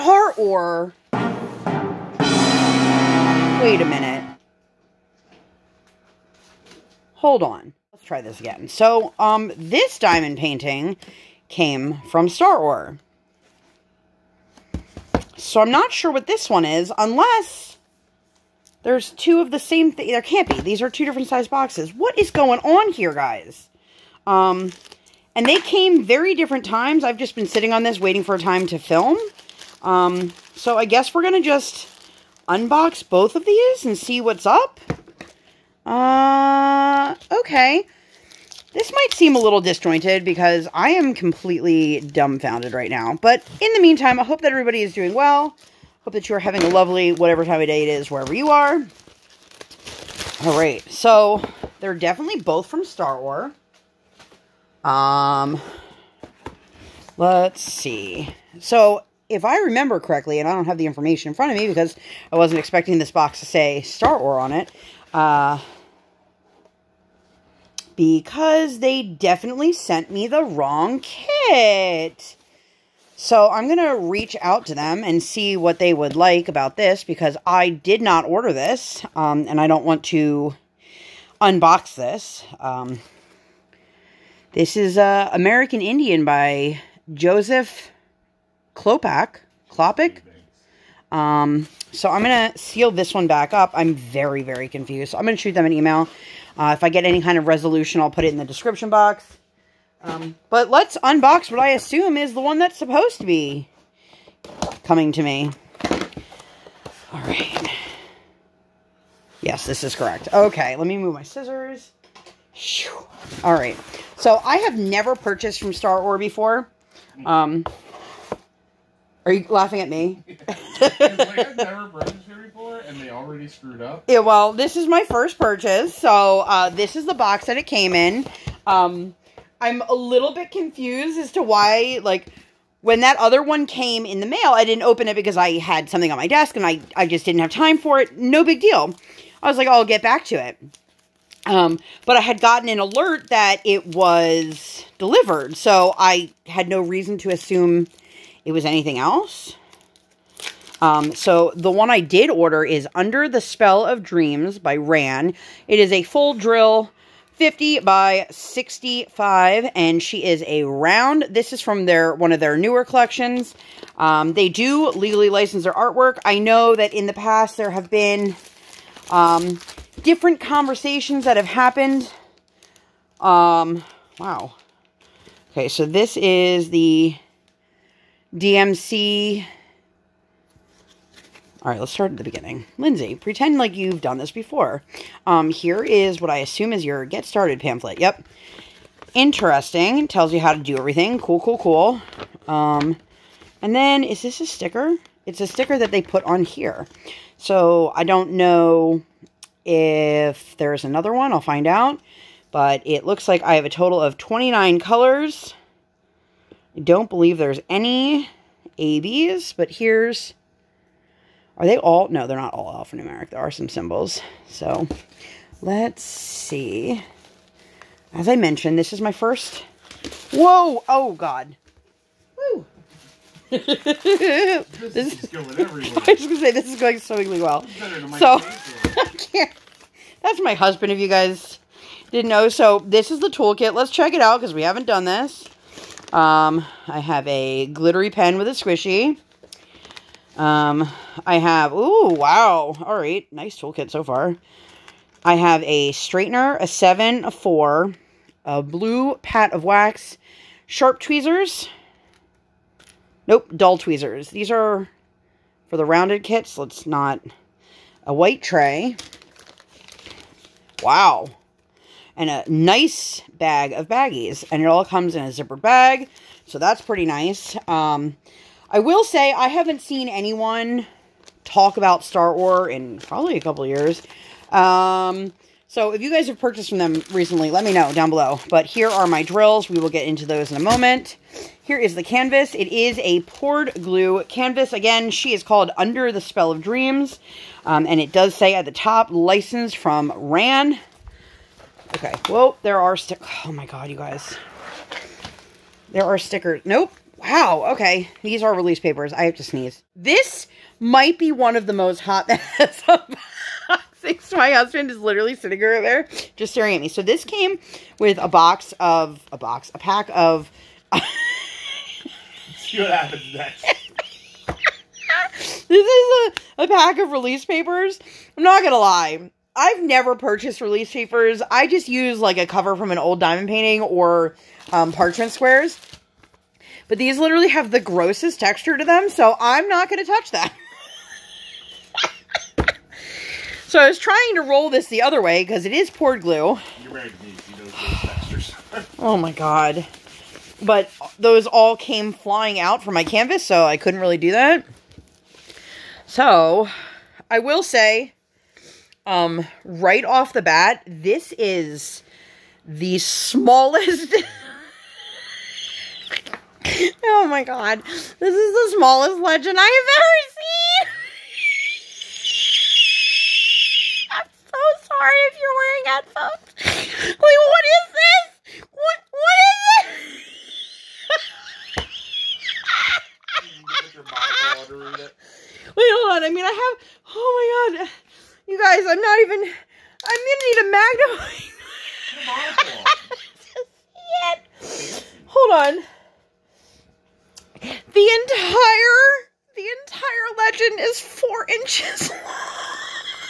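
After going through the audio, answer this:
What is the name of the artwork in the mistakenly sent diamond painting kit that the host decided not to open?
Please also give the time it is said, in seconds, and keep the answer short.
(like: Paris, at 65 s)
American Indian, at 85 s.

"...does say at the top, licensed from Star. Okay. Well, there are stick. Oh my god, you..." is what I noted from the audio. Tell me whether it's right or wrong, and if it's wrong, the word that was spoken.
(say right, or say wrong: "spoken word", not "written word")
wrong: "RAN", not "Star".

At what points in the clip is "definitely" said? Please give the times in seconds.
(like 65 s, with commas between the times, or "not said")
51 s, 69 s.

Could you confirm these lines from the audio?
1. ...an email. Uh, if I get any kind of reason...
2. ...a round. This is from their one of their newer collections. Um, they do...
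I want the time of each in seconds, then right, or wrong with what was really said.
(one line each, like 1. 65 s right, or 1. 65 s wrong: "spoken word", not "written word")
1. 95 s wrong: "resolution", not "reason"
2. 160 s right.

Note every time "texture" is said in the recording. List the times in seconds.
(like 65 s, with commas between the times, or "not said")
328 s.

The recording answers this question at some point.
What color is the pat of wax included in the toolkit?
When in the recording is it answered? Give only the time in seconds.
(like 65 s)
248 s.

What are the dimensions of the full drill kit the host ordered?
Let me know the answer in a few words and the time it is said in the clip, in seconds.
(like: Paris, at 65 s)
50 by 65, at 157 s.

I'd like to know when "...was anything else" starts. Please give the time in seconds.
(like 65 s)
148 s.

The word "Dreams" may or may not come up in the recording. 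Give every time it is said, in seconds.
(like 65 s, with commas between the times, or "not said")
154 s, 286 s.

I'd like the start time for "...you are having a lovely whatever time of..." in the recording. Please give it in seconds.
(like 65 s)
46 s.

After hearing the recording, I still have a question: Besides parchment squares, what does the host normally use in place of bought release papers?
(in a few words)
cover from an old diamond painting.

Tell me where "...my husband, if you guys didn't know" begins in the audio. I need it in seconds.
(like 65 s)
230 s.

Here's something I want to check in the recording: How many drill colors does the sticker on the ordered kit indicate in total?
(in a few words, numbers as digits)
29.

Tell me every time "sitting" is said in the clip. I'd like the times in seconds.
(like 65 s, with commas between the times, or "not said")
27 s, 305 s.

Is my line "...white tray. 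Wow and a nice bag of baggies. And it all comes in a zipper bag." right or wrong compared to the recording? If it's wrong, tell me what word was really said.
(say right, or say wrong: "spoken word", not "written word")
right.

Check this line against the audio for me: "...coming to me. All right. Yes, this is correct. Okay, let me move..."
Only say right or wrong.
right.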